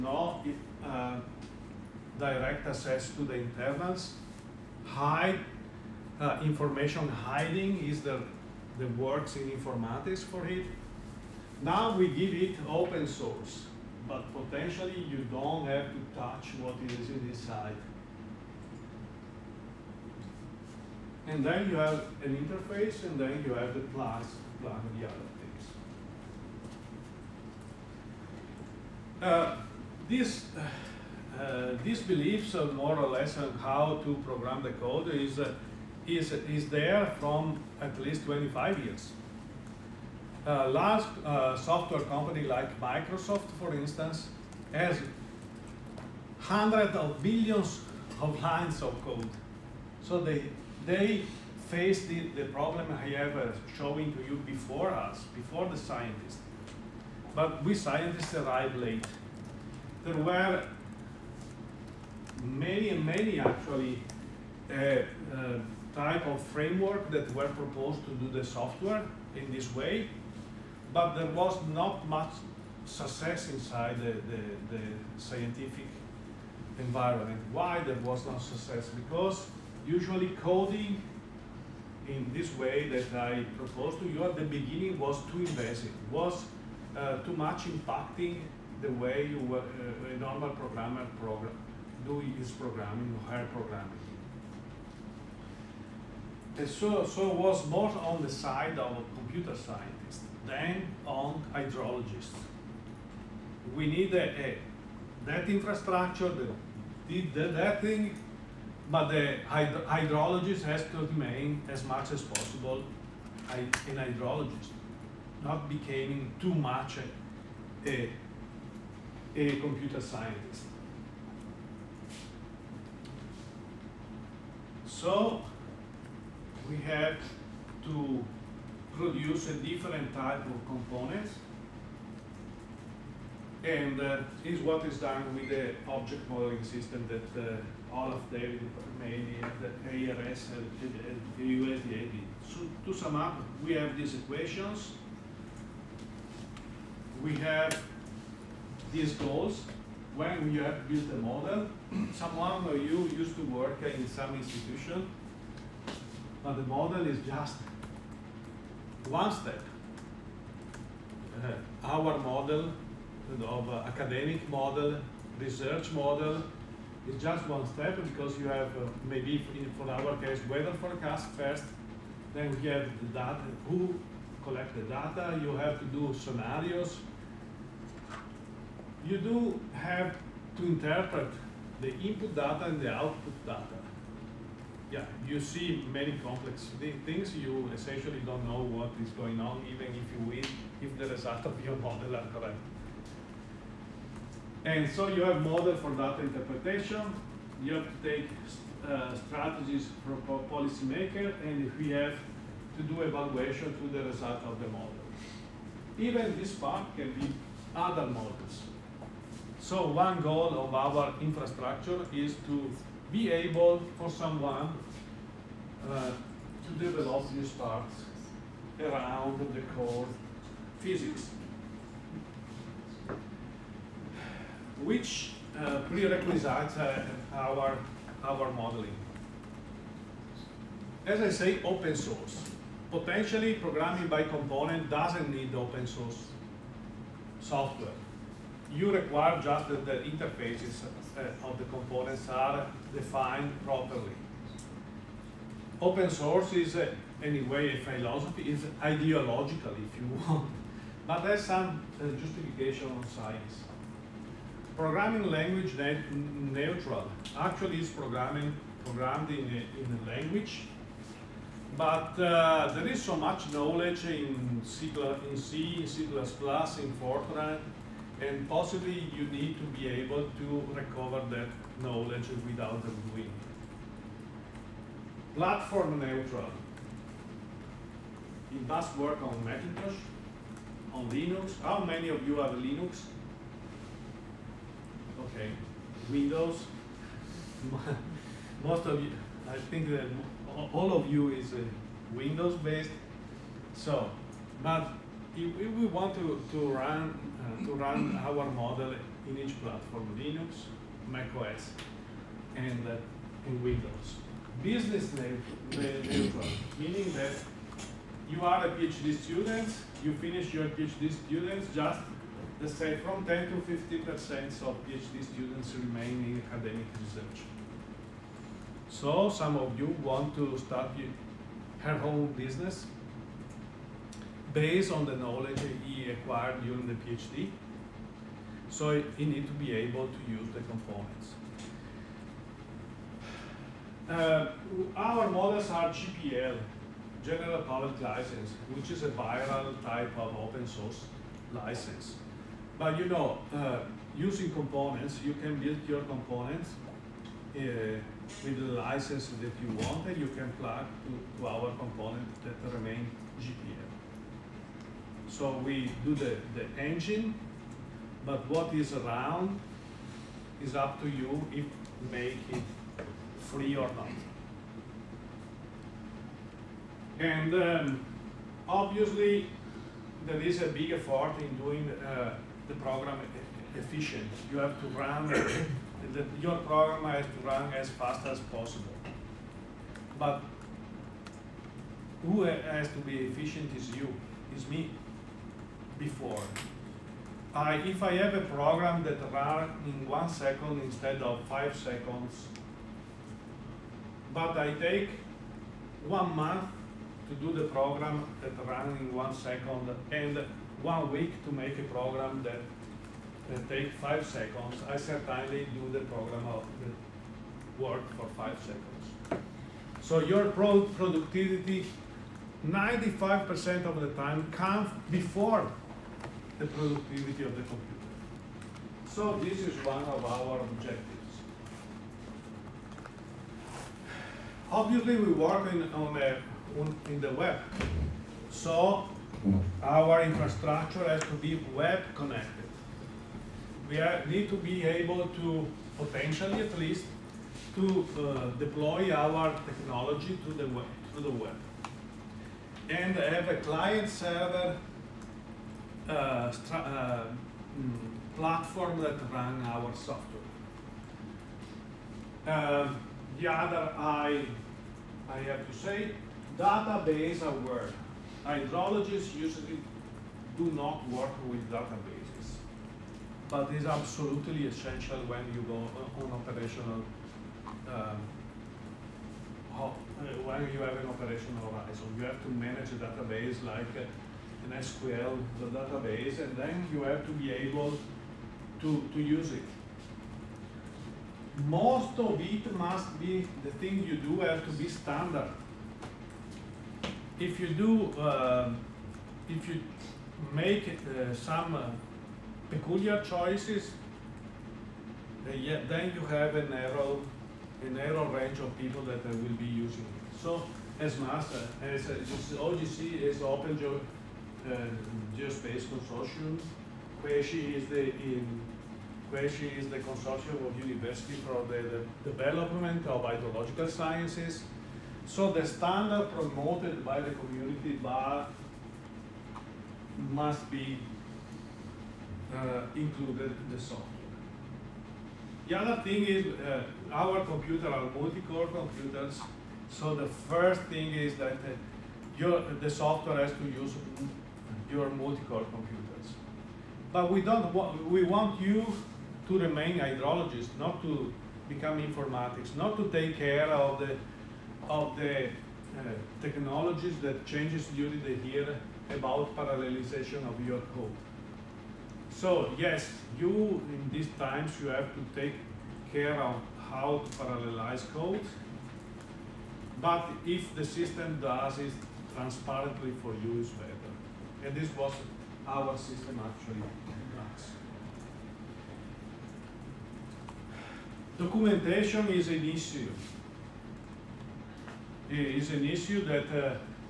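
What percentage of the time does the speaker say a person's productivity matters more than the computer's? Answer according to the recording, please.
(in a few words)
95%.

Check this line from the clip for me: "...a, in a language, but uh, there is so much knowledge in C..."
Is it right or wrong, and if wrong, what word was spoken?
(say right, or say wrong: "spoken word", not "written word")
right.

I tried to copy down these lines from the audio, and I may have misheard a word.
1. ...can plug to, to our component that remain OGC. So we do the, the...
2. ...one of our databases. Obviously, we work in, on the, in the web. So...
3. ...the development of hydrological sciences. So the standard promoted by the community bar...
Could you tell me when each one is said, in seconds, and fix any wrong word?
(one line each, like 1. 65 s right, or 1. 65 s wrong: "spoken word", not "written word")
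1. 350 s wrong: "GPL", not "OGC"
2. 419 s wrong: "objectives", not "databases"
3. 512 s right.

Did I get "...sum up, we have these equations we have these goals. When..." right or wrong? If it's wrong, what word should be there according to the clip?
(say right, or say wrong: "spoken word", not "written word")
right.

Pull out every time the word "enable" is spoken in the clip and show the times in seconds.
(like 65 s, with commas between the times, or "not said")
not said.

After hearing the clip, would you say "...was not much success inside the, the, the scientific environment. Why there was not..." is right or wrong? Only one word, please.
right.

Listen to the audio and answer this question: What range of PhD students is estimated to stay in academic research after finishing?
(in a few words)
10 to 50%.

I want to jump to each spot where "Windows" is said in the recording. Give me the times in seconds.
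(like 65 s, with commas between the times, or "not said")
286 s, 292 s, 303 s.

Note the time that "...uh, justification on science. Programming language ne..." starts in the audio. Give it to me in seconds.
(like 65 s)
252 s.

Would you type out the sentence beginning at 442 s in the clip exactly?
And have a client server uh, uh, mm, platform that ran our software.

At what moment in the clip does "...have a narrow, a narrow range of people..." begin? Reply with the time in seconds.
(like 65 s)
496 s.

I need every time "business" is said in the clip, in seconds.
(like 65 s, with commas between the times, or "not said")
304 s, 322 s.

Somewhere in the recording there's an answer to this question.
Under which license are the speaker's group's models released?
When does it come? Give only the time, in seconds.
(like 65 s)
337 s.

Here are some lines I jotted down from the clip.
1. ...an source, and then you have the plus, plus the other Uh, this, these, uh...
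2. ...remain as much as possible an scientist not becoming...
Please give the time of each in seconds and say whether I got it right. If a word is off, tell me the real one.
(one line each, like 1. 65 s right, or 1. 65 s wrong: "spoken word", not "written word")
1. 22 s wrong: "interface", not "source"
2. 111 s wrong: "hydrologist", not "scientist".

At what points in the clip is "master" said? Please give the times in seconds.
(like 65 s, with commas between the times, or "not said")
501 s.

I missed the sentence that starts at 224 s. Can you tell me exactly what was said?
Which uh, prerequisites uh, our, our modeling?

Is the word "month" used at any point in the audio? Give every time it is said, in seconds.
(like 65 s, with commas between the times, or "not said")
396 s.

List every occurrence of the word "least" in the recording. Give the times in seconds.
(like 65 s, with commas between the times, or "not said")
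37 s, 436 s.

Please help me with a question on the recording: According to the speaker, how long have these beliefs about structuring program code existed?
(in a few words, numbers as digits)
25 years.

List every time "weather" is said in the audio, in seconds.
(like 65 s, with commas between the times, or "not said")
170 s.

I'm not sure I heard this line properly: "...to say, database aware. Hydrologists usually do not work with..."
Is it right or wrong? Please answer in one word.
right.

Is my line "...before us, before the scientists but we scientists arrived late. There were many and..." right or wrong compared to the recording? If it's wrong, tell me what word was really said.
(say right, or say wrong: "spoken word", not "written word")
right.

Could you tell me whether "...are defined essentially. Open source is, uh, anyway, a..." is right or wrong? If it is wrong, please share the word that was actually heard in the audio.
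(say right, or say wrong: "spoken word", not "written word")
wrong: "properly", not "essentially".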